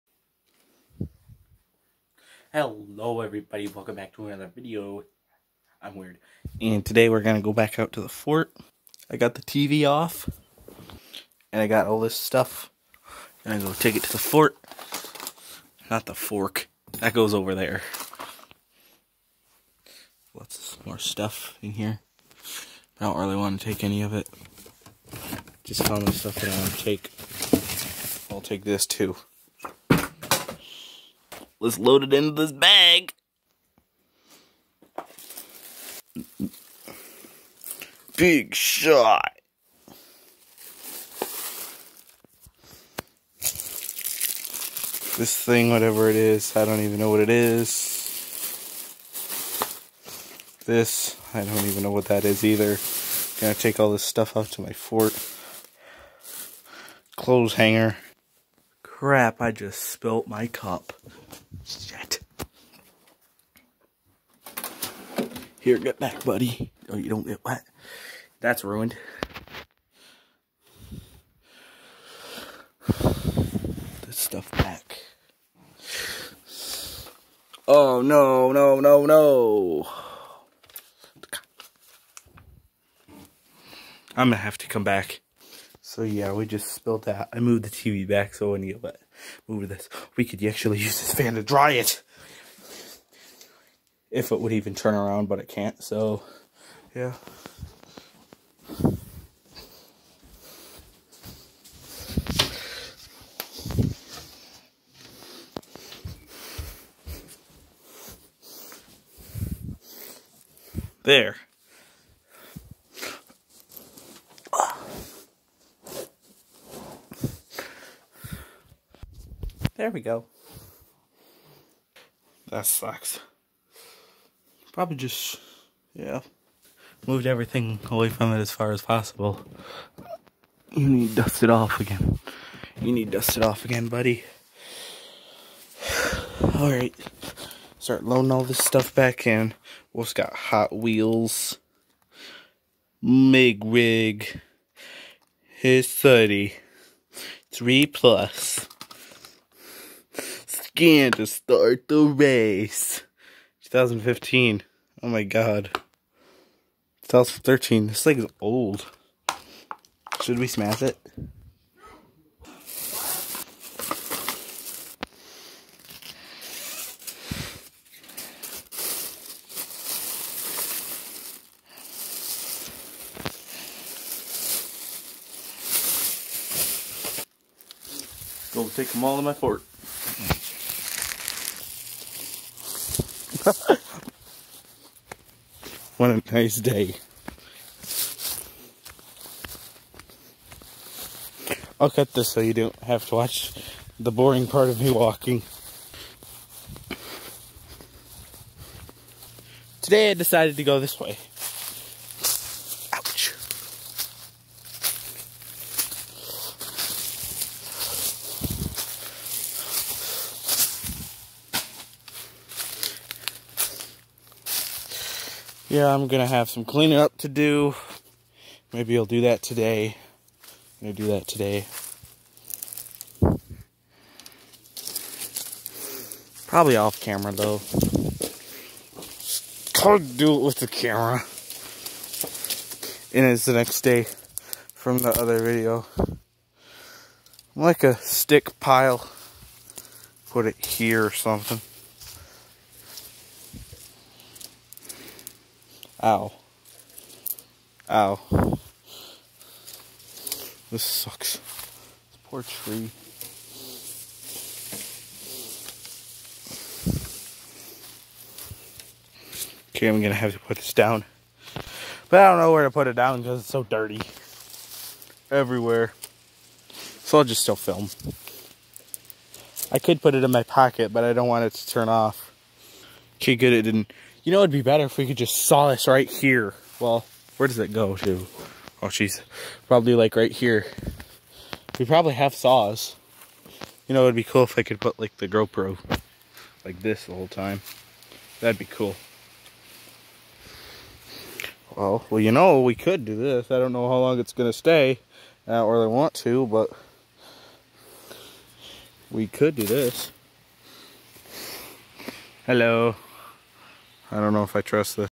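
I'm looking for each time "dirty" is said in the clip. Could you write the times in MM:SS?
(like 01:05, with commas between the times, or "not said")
04:23.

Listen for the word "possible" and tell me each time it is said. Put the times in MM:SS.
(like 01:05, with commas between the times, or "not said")
02:08.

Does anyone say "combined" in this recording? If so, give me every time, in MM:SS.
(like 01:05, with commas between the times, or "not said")
not said.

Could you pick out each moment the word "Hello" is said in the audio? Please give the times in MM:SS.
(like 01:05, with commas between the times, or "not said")
00:02, 05:02.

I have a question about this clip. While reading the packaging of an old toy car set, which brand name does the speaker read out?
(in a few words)
Hot Wheels.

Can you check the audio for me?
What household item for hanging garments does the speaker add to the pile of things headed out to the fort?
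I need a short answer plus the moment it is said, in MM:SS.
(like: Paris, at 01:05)
Clothes hanger, at 00:57.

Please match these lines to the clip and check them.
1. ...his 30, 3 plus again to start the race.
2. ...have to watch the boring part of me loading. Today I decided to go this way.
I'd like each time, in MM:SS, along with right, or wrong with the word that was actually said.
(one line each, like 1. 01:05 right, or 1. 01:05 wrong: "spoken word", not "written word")
1. 02:25 right
2. 03:12 wrong: "walking", not "loading".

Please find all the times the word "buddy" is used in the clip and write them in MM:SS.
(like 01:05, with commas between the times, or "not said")
01:06, 02:13.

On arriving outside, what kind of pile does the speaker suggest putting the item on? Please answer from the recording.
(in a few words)
stick pile.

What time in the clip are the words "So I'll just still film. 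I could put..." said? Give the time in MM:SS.
04:27.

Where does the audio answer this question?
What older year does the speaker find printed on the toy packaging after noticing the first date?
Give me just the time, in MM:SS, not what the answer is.
02:37.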